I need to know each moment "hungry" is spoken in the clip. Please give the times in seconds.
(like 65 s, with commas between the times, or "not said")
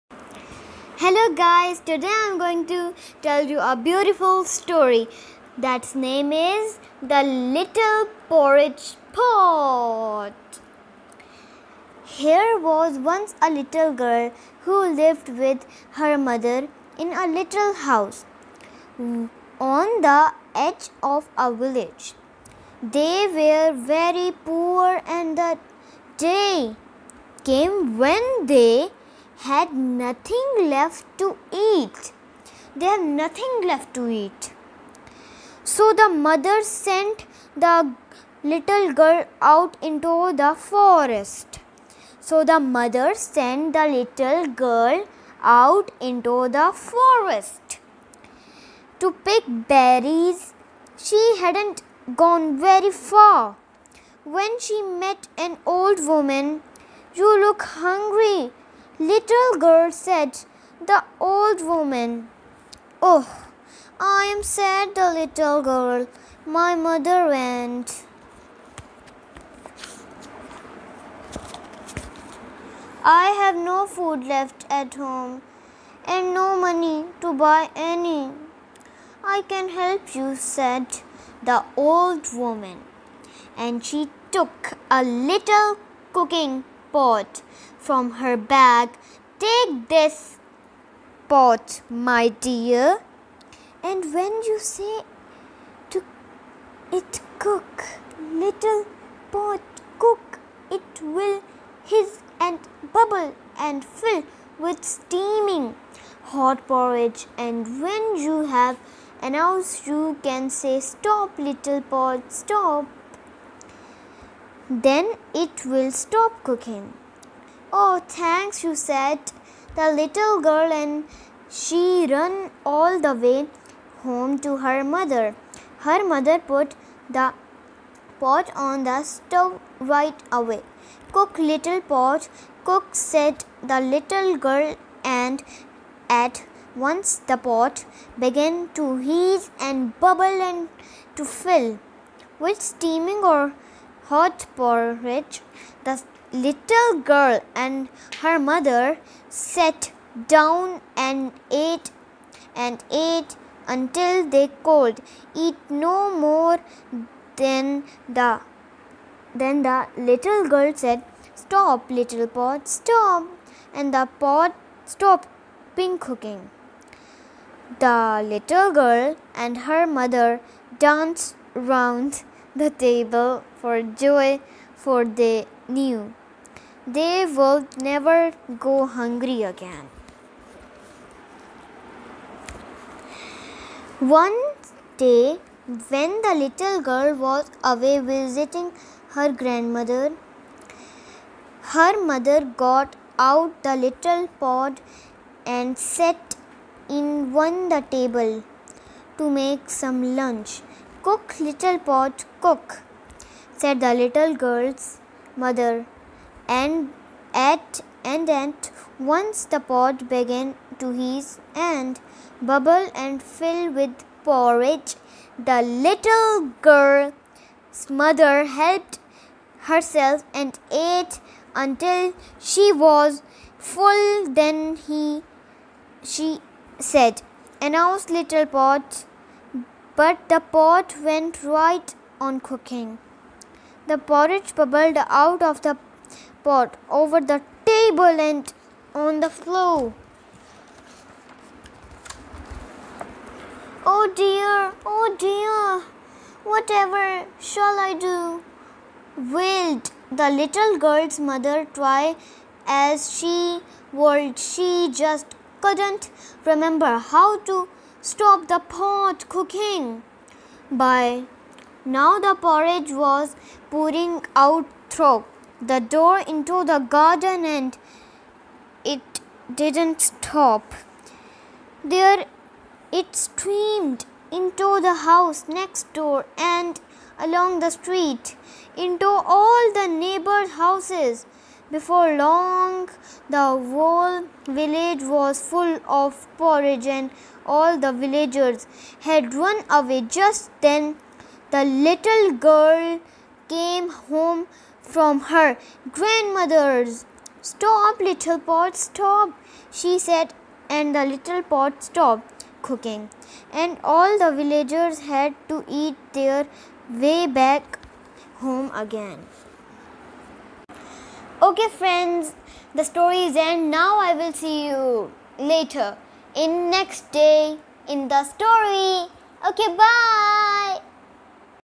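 57 s, 178 s.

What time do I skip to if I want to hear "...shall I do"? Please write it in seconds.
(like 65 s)
247 s.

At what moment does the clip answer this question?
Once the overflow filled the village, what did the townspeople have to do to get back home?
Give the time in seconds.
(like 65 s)
305 s.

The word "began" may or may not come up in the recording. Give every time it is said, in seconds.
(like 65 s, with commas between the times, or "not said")
138 s, 210 s.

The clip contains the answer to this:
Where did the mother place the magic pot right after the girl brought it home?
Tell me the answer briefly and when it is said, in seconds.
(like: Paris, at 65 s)
on the stove, at 128 s.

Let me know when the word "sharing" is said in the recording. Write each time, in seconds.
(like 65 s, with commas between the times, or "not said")
not said.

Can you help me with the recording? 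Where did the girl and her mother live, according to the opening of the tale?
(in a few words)
edge of a village.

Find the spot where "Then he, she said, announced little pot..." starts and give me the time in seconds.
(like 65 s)
224 s.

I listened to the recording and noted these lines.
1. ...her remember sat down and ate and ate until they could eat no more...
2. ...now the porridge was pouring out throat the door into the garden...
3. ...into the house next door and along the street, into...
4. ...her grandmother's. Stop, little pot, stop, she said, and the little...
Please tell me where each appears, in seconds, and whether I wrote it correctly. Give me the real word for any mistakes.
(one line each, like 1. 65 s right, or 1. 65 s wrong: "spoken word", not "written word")
1. 148 s wrong: "mother", not "remember"
2. 261 s right
3. 274 s right
4. 295 s right.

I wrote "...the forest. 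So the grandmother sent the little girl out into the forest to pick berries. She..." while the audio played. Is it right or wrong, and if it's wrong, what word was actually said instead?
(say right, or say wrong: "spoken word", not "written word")
wrong: "mother", not "grandmother".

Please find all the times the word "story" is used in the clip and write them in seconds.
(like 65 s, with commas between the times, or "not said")
4 s, 312 s, 318 s.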